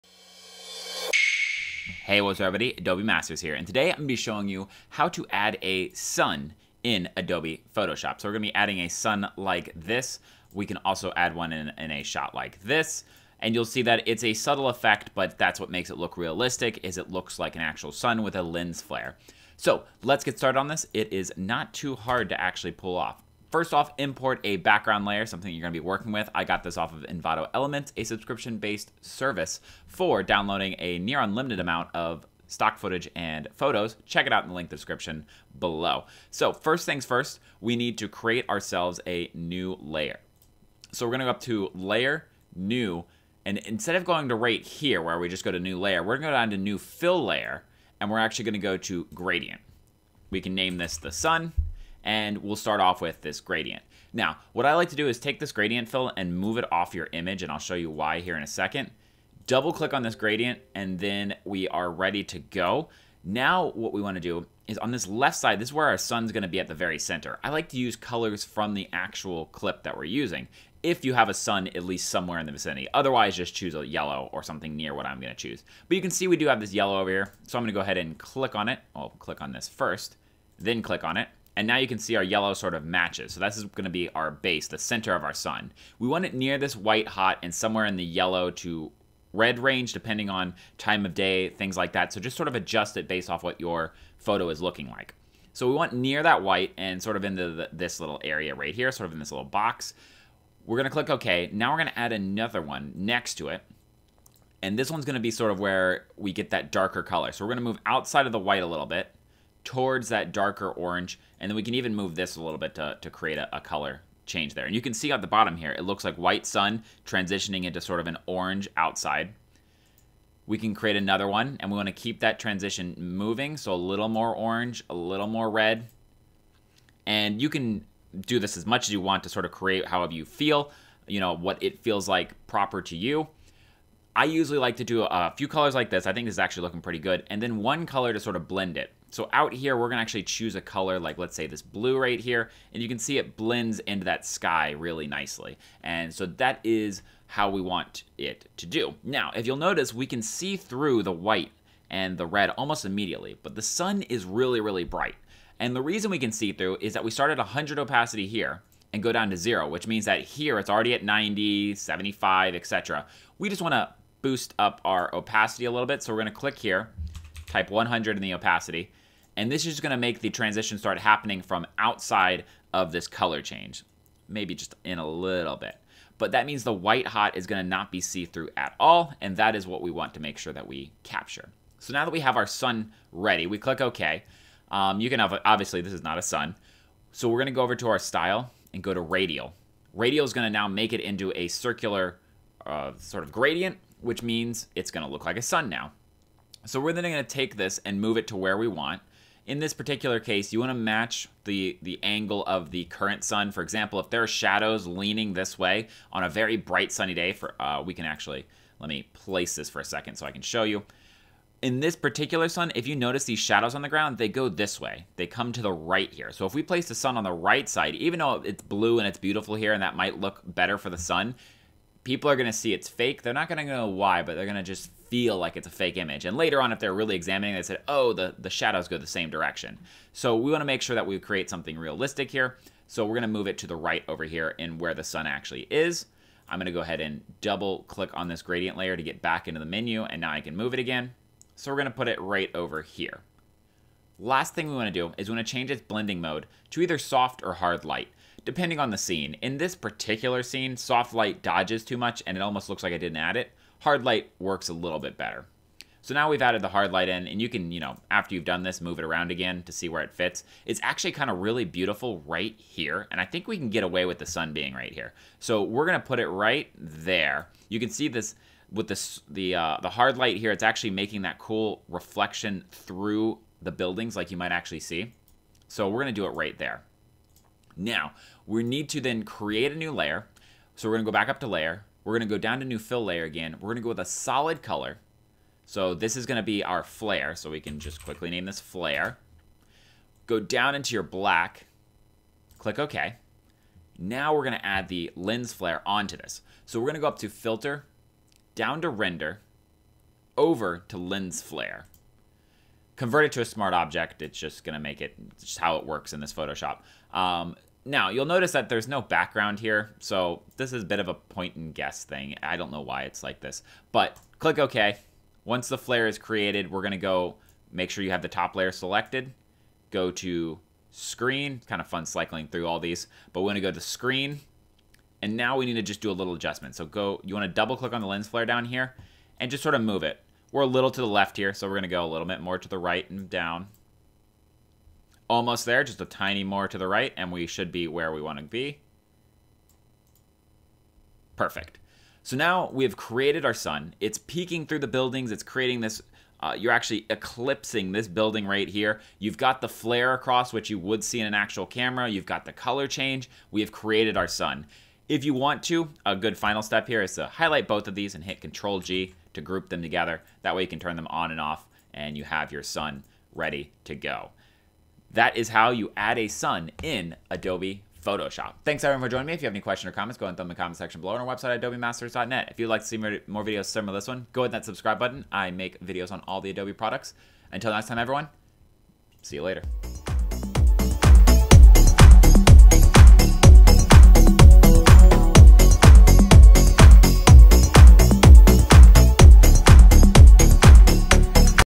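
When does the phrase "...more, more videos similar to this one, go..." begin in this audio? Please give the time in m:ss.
6:12.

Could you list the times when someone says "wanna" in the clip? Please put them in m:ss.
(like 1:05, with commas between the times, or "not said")
1:04, 2:43.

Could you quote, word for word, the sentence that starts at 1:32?
So just sort of adjust it based off what your photo is looking like.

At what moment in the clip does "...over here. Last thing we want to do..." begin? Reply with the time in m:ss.
4:02.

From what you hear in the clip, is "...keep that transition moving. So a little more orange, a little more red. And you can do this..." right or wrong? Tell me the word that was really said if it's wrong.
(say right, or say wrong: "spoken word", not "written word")
right.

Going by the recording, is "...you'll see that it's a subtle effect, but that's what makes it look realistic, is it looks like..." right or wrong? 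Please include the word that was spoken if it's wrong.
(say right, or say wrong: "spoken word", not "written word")
right.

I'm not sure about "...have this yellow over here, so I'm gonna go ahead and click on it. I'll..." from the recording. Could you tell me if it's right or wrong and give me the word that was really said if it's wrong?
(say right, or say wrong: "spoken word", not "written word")
right.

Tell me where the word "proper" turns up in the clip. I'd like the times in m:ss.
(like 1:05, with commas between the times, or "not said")
2:12.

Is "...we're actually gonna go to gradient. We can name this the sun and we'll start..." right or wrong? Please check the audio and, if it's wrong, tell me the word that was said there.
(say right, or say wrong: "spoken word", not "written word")
right.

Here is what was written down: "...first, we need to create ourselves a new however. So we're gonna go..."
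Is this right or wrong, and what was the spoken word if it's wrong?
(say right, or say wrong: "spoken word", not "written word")
wrong: "layer", not "however".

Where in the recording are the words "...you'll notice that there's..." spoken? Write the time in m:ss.
5:08.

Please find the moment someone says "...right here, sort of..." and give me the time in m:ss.
1:38.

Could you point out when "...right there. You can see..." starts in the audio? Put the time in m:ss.
4:26.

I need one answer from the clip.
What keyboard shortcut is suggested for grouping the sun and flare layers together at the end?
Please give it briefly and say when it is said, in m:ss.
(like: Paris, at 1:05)
Control G, at 5:58.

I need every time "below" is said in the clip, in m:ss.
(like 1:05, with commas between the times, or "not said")
0:35, 6:11.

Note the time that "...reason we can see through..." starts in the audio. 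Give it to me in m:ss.
2:35.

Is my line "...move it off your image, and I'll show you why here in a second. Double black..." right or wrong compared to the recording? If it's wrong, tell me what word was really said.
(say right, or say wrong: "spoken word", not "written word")
wrong: "click", not "black".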